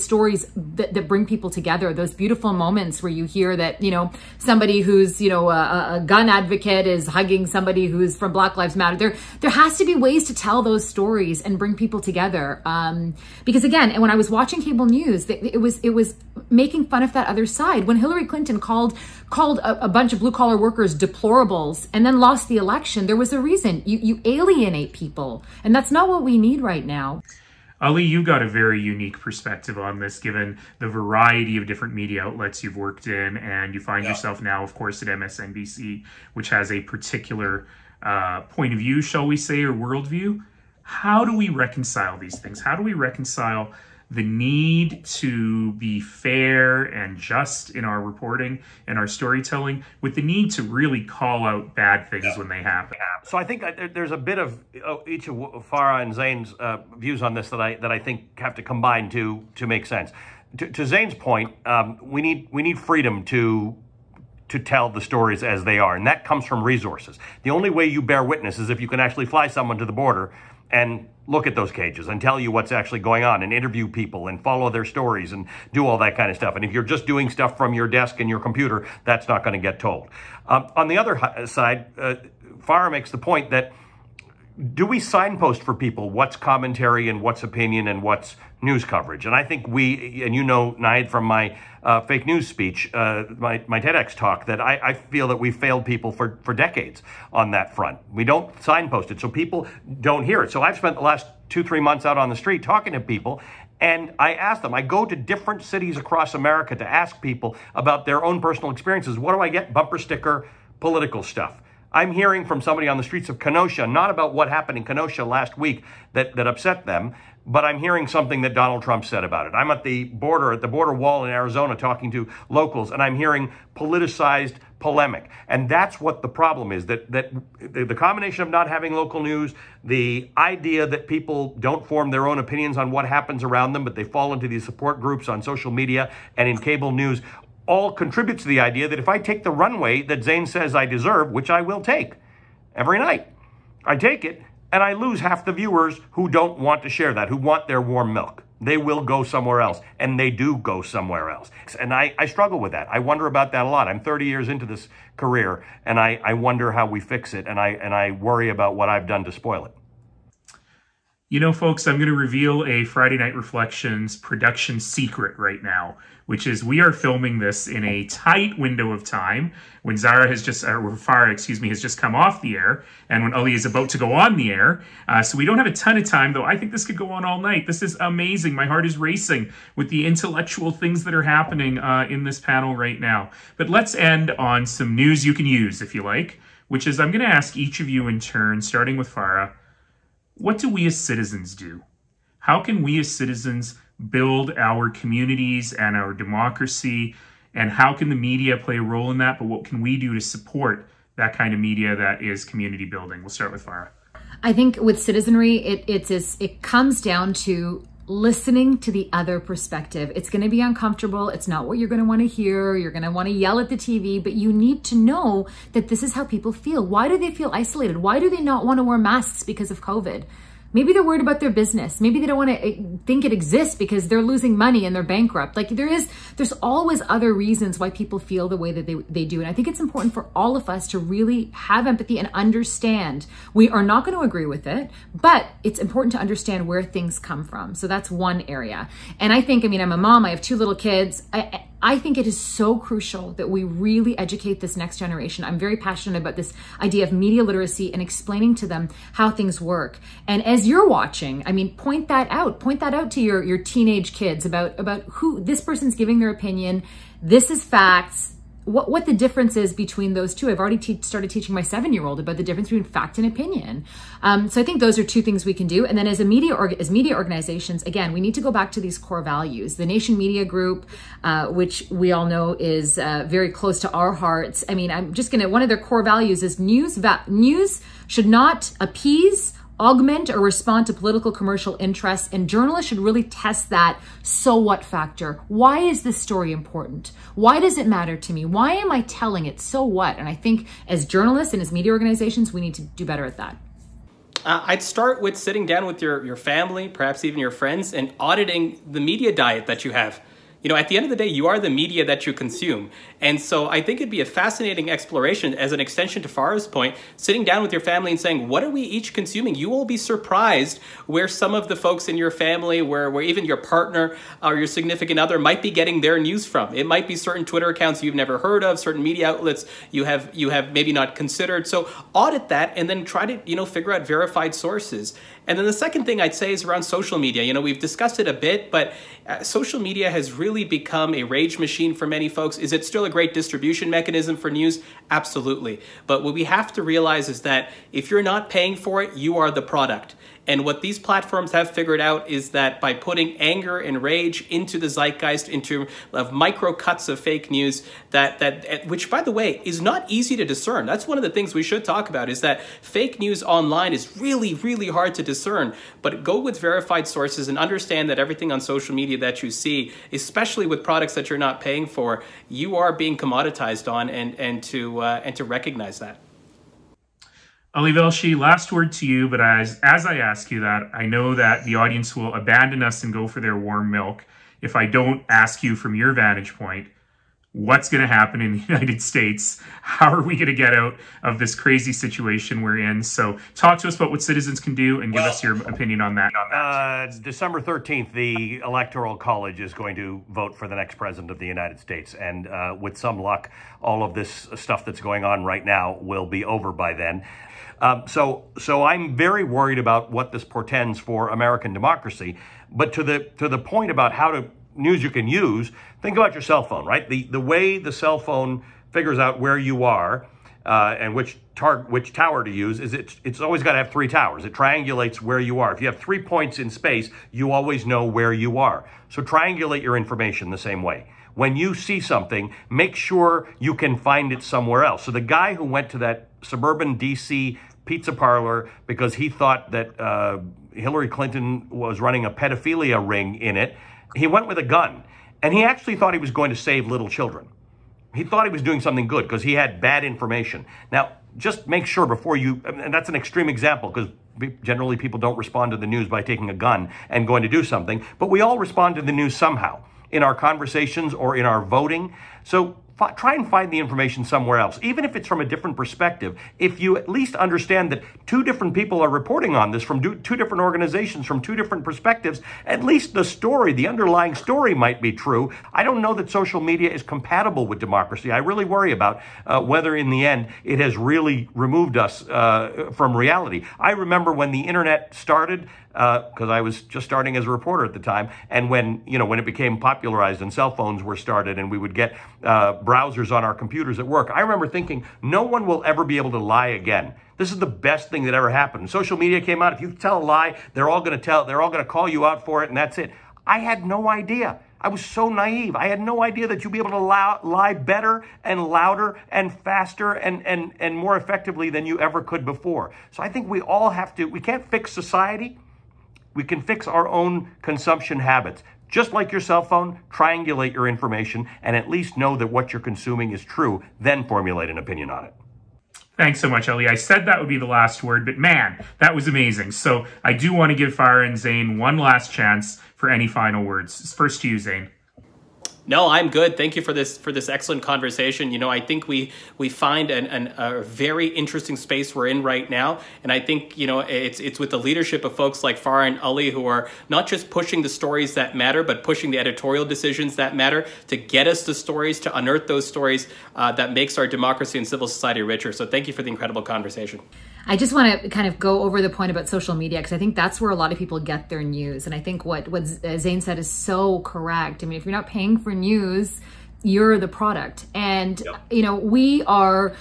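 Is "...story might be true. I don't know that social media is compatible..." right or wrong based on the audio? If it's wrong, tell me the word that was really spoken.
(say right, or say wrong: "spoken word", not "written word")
right.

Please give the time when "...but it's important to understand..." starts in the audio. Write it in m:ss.
3:55.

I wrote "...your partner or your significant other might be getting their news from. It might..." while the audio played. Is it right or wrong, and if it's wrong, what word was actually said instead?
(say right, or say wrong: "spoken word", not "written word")
right.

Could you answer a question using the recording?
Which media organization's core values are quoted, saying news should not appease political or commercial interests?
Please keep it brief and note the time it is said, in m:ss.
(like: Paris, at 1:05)
Nation Media Group, at 4:29.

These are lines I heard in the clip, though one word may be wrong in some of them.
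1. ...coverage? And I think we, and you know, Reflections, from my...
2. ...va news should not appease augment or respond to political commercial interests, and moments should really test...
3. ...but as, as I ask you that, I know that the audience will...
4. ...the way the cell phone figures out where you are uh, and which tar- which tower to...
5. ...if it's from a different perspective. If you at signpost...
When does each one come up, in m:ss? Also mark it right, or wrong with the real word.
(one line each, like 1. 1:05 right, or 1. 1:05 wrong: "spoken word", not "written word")
1. 1:28 wrong: "Naheed", not "Reflections"
2. 4:36 wrong: "journalists", not "moments"
3. 6:09 right
4. 6:47 right
5. 7:35 wrong: "least", not "signpost".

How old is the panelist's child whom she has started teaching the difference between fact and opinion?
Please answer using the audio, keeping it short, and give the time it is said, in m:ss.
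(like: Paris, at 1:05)
7, at 4:21.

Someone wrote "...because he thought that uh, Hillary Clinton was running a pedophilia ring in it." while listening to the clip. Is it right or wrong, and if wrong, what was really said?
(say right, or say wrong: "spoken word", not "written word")
right.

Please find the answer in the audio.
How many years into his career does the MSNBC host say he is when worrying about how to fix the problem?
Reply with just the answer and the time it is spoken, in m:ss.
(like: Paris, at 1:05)
30, at 2:33.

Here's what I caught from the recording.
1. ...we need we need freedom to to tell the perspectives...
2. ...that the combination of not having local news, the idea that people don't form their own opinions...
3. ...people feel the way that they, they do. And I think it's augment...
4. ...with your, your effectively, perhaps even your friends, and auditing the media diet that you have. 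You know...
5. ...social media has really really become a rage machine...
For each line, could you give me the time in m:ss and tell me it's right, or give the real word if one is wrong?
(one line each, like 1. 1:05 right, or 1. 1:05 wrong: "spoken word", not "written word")
1. 1:02 wrong: "stories", not "perspectives"
2. 2:07 right
3. 3:47 wrong: "important", not "augment"
4. 4:55 wrong: "family", not "effectively"
5. 5:29 right.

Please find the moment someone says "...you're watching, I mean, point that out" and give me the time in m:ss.
4:10.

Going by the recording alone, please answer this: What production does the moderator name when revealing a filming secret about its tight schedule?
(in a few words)
Friday Night Reflections.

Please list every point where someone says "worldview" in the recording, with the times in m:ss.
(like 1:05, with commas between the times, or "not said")
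0:39.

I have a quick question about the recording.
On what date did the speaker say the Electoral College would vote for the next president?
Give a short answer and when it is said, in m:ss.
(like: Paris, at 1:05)
December 13, at 6:27.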